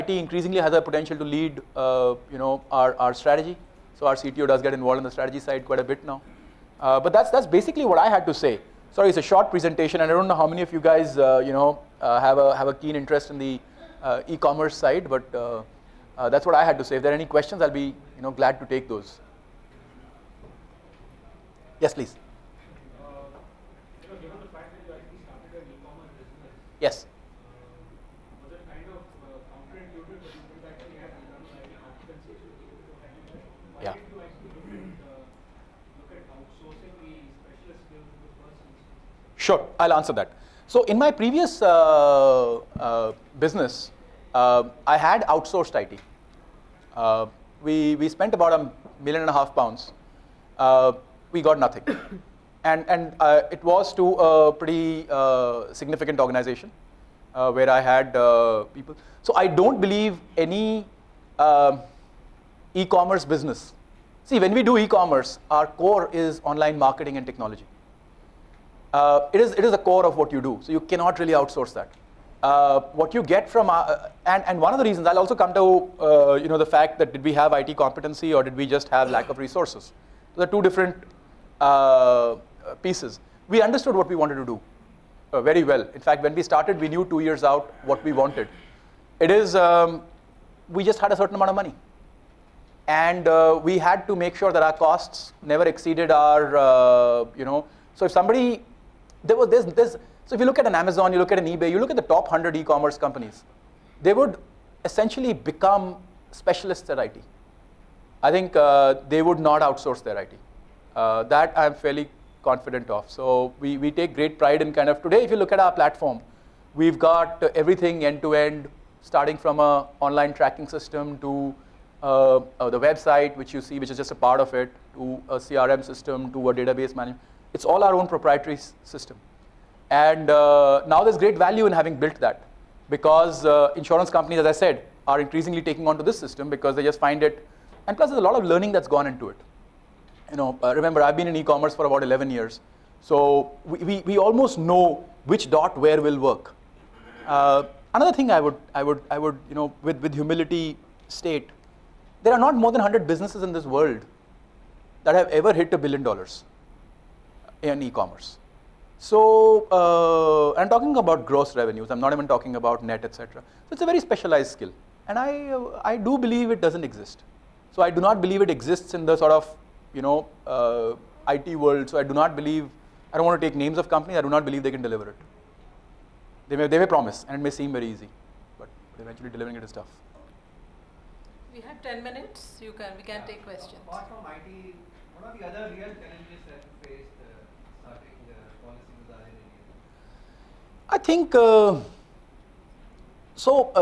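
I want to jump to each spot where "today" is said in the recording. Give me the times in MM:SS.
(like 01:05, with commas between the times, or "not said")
01:55.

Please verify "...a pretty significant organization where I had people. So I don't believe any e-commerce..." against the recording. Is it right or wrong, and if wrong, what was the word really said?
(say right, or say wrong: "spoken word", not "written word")
right.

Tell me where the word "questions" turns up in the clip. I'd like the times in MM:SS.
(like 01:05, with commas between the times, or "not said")
00:17, 03:03.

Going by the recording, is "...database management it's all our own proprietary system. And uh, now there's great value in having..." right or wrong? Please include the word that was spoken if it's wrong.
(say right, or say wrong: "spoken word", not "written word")
right.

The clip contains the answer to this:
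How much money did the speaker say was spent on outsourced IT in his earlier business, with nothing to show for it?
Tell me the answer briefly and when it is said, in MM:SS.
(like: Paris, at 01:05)
1.5 million pounds, at 00:48.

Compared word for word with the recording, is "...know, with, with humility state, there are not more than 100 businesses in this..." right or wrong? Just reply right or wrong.
right.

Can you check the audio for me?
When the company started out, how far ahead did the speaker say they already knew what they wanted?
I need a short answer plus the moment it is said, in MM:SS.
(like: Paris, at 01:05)
2 years, at 01:27.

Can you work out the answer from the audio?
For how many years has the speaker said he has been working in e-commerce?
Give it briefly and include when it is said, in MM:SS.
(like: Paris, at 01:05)
11 years, at 02:22.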